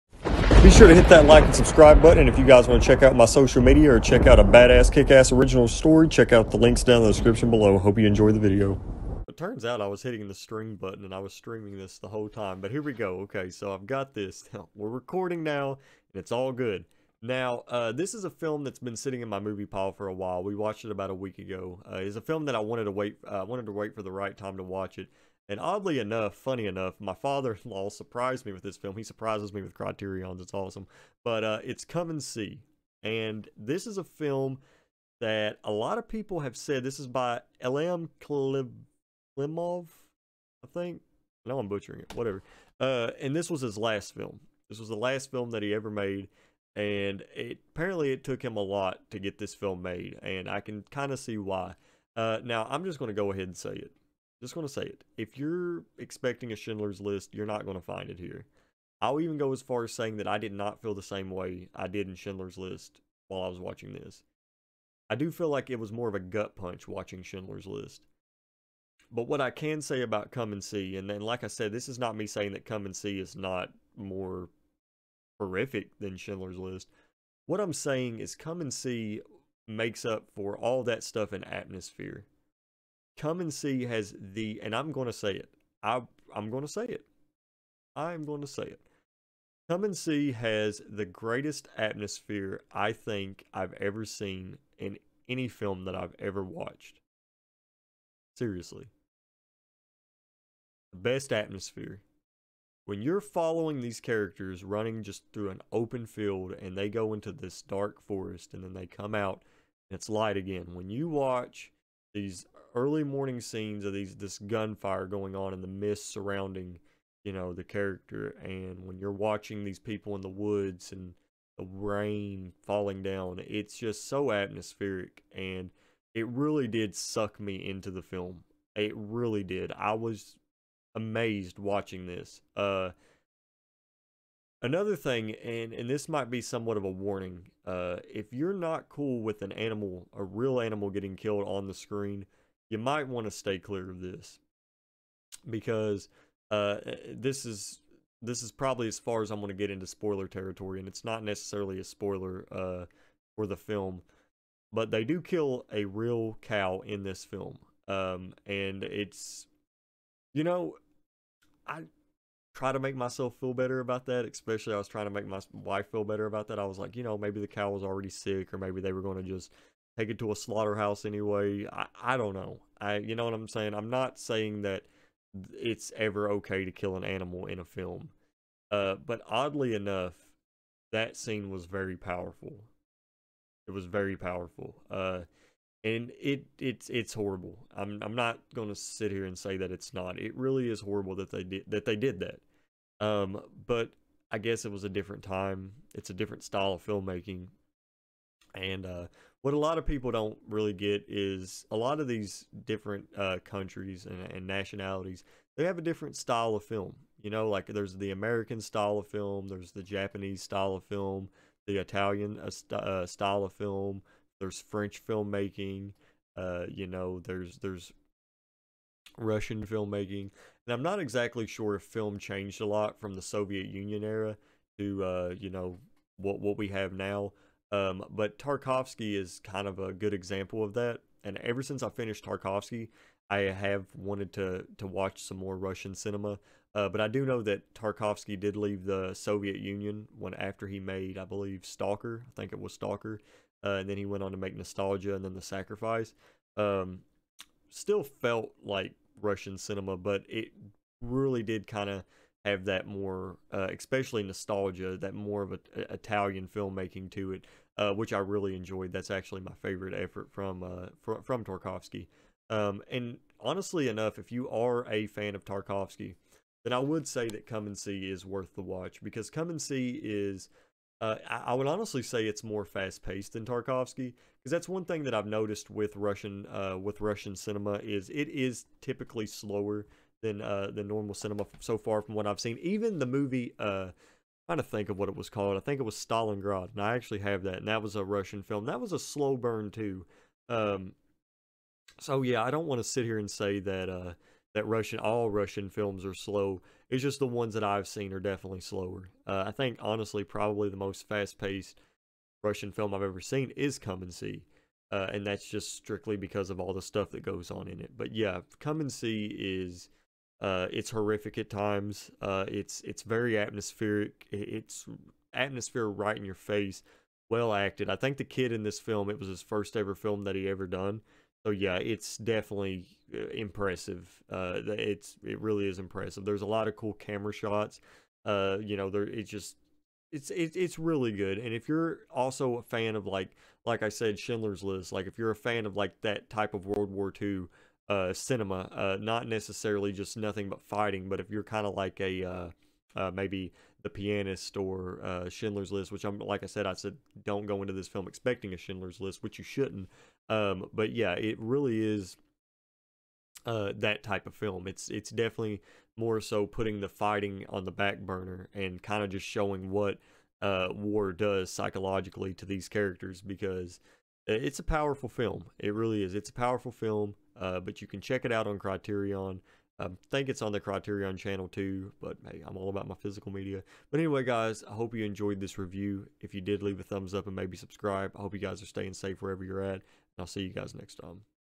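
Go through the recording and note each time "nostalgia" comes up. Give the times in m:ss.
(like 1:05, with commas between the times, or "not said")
4:04, 4:14.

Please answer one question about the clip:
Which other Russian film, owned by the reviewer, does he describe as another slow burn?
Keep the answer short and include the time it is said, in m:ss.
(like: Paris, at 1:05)
Stalingrad, at 4:45.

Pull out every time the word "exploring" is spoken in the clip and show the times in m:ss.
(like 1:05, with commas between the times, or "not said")
not said.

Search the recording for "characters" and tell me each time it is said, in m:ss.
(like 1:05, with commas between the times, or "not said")
1:44, 1:57, 6:02.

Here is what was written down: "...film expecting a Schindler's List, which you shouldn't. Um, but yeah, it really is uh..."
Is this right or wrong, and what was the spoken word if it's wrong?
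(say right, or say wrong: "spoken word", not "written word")
right.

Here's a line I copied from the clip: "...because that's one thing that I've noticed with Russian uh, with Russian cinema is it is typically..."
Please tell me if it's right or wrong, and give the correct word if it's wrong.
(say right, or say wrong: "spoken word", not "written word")
right.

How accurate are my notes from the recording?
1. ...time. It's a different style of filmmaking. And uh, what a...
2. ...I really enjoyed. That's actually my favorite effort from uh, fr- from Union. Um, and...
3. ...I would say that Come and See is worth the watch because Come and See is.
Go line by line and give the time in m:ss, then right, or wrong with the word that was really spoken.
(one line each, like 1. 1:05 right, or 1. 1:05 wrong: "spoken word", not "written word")
1. 3:15 right
2. 4:18 wrong: "Tarkovsky", not "Union"
3. 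4:26 right.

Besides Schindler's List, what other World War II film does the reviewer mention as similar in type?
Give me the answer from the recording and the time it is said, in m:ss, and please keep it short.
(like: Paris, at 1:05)
The Pianist, at 5:43.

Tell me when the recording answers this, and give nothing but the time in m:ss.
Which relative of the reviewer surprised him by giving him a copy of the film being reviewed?
0:27.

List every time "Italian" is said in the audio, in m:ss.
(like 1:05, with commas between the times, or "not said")
3:31, 4:15.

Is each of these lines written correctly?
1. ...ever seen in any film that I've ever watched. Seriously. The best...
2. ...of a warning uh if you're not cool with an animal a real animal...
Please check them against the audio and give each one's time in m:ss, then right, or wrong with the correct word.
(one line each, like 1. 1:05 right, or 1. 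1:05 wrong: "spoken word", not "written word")
1. 1:33 right
2. 2:16 right.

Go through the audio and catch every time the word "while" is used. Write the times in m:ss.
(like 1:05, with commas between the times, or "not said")
0:20, 1:03.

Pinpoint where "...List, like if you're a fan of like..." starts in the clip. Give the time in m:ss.
5:34.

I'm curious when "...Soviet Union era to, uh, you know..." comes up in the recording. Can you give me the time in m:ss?
3:43.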